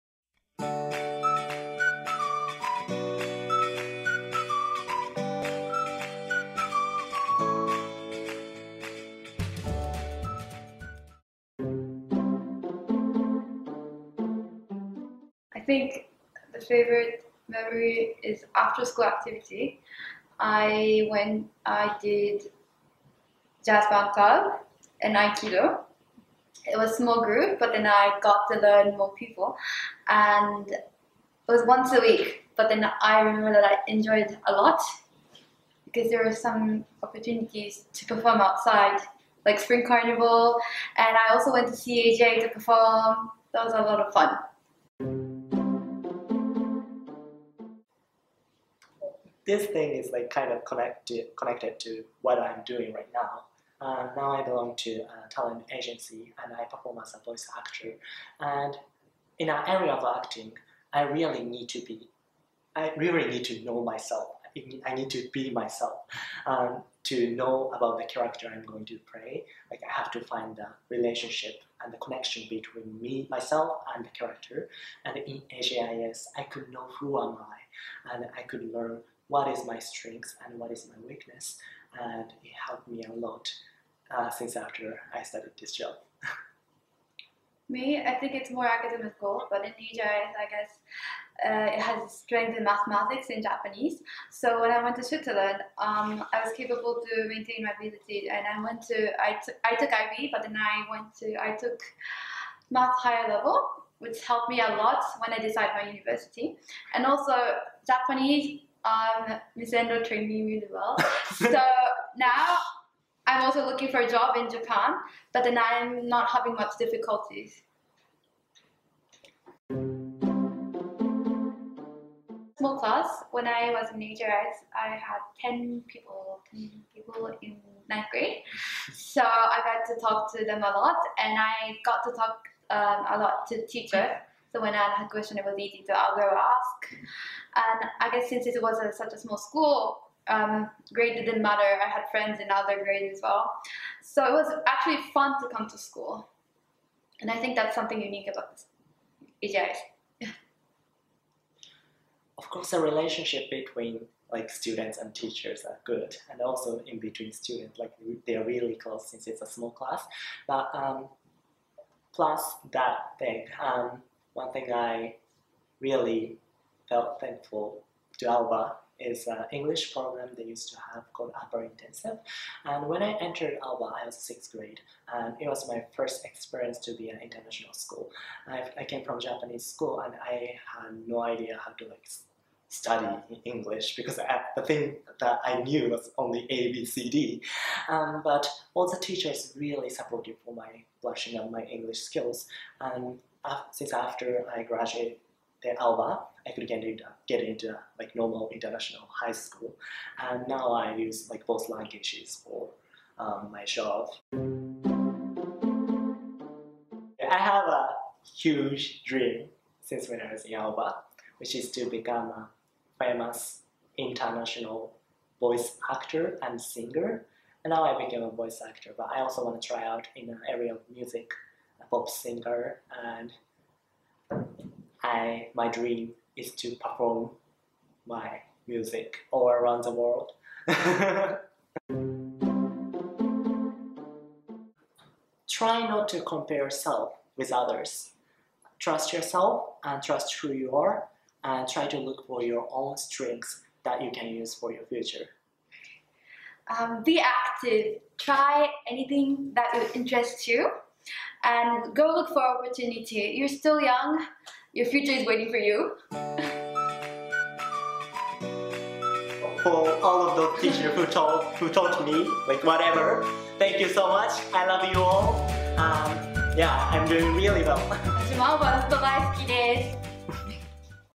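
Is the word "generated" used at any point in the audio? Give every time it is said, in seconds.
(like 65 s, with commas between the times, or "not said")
not said.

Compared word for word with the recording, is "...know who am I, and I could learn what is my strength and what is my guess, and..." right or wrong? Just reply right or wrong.
wrong.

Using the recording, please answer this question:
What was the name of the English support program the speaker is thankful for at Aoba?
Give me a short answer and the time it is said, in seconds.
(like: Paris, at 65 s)
Upper Intensive, at 171 s.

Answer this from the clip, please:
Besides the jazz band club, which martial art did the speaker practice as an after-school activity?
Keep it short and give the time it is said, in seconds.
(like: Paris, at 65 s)
Aikido, at 25 s.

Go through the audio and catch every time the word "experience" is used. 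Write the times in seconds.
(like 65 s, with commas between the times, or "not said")
176 s.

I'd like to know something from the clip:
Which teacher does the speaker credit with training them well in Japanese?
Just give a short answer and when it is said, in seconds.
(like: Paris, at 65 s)
Miss Endo, at 109 s.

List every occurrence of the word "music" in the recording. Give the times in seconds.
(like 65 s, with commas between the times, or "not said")
220 s, 228 s.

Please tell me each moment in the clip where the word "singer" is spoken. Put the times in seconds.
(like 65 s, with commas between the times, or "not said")
216 s, 222 s.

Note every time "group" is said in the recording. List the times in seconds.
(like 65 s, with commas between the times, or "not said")
27 s.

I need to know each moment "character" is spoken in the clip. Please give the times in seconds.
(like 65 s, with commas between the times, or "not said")
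68 s, 74 s.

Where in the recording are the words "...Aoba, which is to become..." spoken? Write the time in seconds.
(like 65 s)
210 s.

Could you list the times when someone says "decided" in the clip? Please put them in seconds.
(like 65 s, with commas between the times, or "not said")
105 s.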